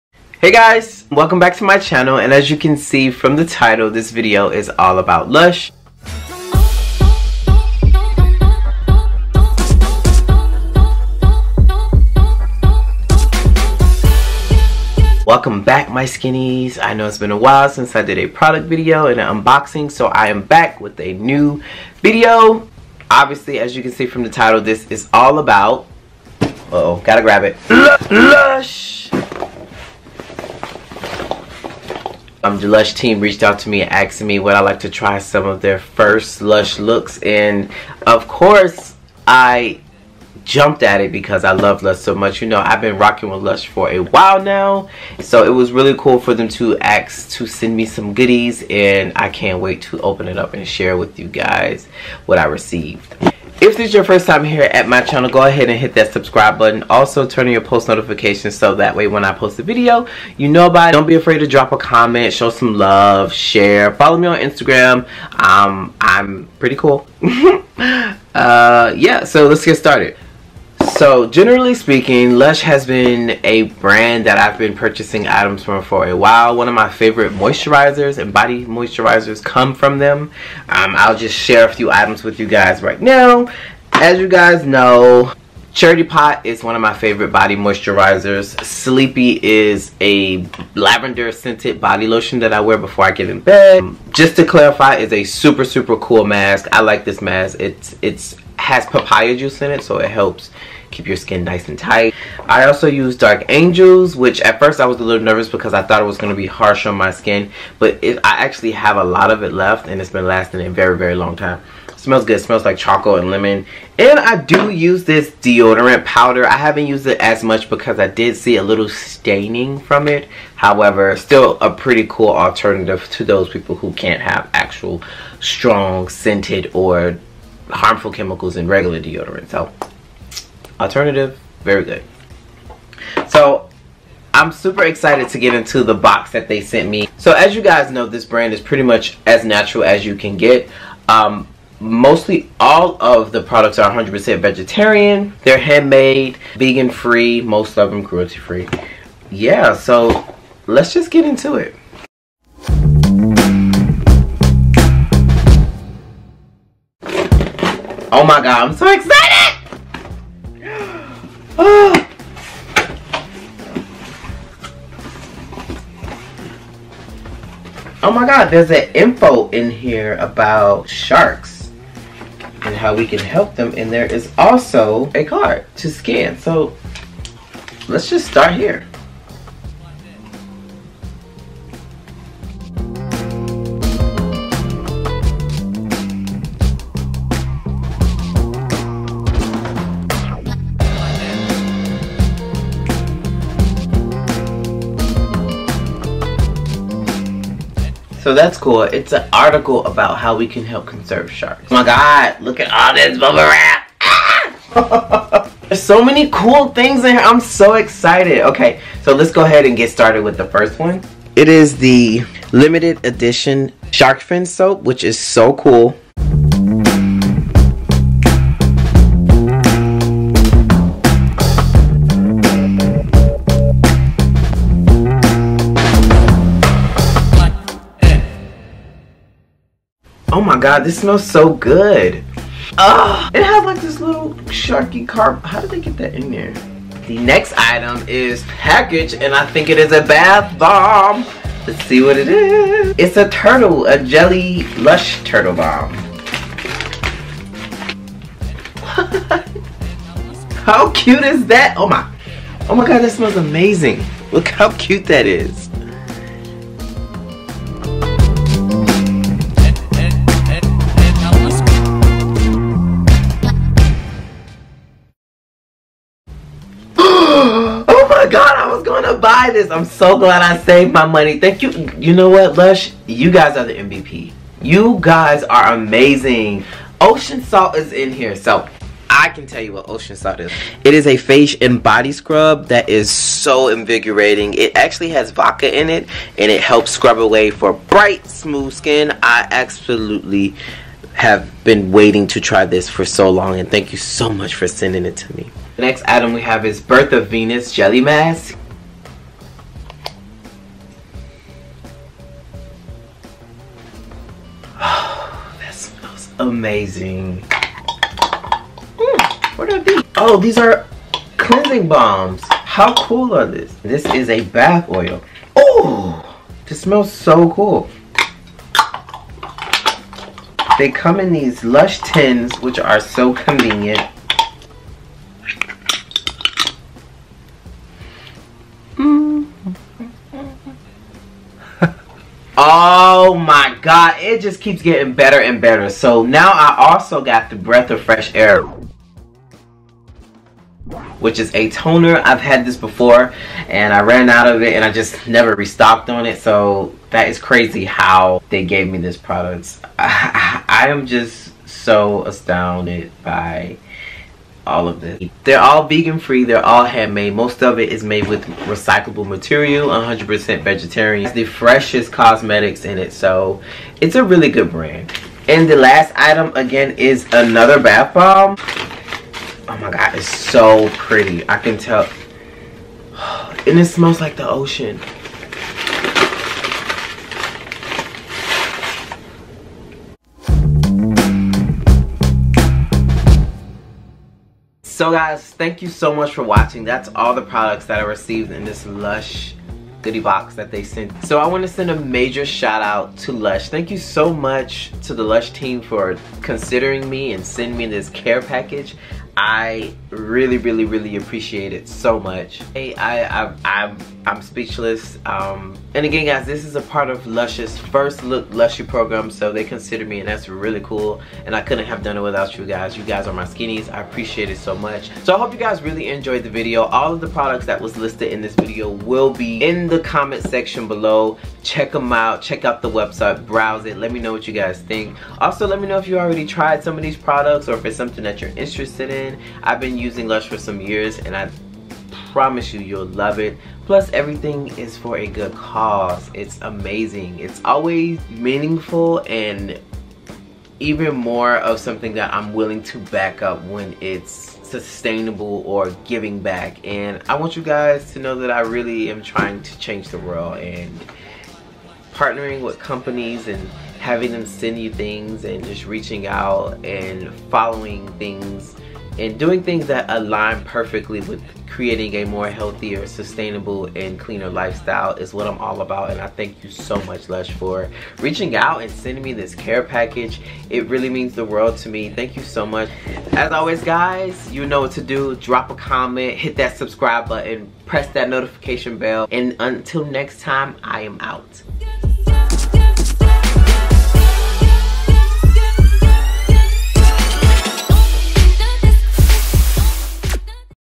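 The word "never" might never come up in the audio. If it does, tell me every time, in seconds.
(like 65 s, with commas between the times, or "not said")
345 s.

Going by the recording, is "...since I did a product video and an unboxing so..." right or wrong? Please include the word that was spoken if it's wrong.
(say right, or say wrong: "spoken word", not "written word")
right.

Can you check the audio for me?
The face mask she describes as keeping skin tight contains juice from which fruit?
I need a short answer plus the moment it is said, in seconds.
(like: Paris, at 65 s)
Papaya, at 98 s.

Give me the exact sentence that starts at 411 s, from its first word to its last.
And I couldn't have done it without you guys.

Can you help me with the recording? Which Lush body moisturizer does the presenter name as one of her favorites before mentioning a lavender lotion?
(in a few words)
Charity Pot.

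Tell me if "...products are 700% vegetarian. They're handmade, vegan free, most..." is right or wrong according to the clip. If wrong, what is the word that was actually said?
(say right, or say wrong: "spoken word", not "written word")
wrong: "100", not "700".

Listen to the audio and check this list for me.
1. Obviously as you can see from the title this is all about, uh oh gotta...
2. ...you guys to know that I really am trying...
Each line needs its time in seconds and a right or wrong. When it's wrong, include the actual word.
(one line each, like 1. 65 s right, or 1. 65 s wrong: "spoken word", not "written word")
1. 23 s right
2. 447 s right.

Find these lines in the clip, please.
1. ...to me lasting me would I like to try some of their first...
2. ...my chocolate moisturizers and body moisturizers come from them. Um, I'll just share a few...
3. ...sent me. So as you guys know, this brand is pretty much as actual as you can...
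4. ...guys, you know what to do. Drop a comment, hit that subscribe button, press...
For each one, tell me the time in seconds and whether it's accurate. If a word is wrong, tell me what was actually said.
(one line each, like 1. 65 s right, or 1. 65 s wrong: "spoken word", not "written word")
1. 33 s wrong: "asking", not "lasting"
2. 76 s wrong: "favorite", not "chocolate"
3. 136 s wrong: "natural", not "actual"
4. 473 s right.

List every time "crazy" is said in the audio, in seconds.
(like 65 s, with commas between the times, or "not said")
347 s.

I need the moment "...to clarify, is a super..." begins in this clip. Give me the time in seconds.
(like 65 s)
94 s.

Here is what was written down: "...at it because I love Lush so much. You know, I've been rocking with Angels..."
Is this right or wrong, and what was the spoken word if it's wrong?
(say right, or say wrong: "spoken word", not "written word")
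wrong: "Lush", not "Angels".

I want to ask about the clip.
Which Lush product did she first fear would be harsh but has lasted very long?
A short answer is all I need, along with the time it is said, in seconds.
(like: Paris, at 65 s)
Dark Angels, at 103 s.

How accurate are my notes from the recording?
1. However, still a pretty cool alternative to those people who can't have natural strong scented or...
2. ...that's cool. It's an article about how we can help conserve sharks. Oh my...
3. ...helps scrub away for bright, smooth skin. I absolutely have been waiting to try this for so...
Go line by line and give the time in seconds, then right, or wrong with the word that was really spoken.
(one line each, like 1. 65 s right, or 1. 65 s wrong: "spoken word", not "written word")
1. 120 s wrong: "actual", not "natural"
2. 198 s right
3. 286 s right.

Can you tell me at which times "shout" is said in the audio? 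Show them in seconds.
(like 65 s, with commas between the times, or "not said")
392 s.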